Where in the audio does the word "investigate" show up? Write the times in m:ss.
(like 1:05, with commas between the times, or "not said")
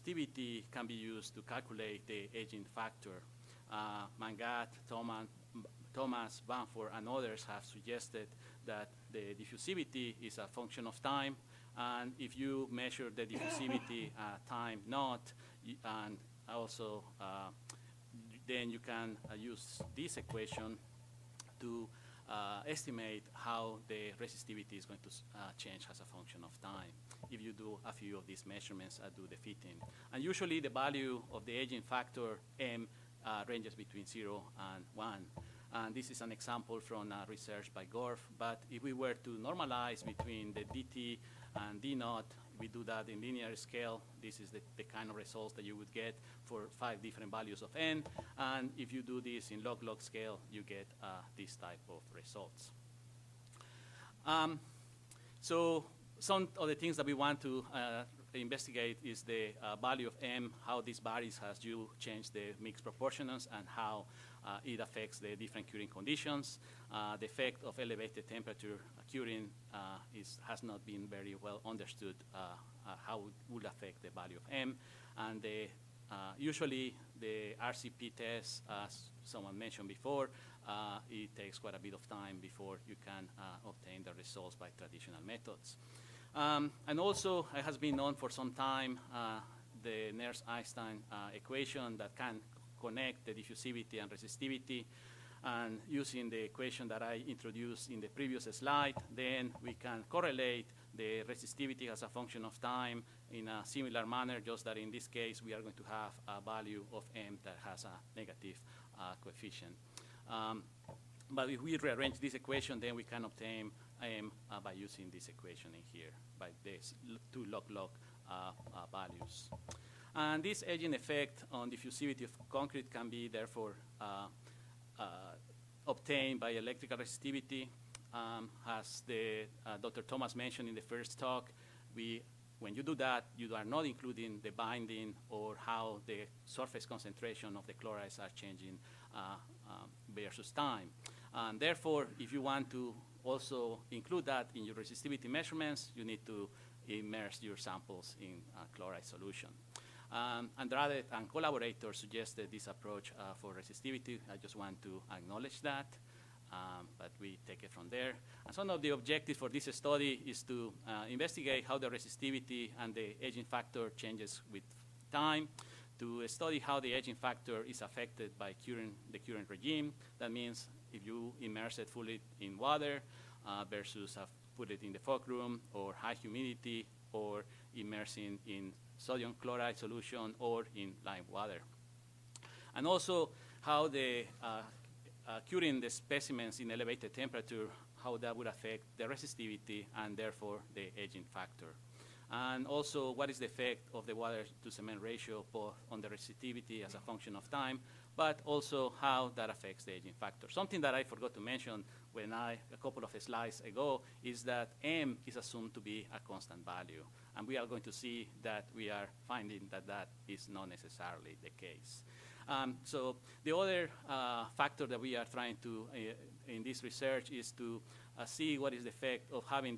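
0:58, 2:41.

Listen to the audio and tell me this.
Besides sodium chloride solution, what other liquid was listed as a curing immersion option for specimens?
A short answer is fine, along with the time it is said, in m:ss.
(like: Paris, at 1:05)
lime water, at 3:01.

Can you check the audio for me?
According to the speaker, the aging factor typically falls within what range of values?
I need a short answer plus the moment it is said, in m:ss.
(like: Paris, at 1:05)
between 0 and 1, at 0:33.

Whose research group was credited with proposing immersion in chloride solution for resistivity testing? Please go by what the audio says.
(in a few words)
Andrade.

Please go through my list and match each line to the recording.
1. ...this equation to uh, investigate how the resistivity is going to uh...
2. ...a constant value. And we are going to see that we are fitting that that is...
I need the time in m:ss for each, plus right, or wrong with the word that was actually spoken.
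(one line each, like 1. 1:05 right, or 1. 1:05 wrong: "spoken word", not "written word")
1. 0:19 wrong: "estimate", not "investigate"
2. 3:26 wrong: "finding", not "fitting".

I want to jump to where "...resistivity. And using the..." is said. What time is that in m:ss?
1:34.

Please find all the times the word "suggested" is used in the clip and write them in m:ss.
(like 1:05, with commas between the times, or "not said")
0:07, 2:31.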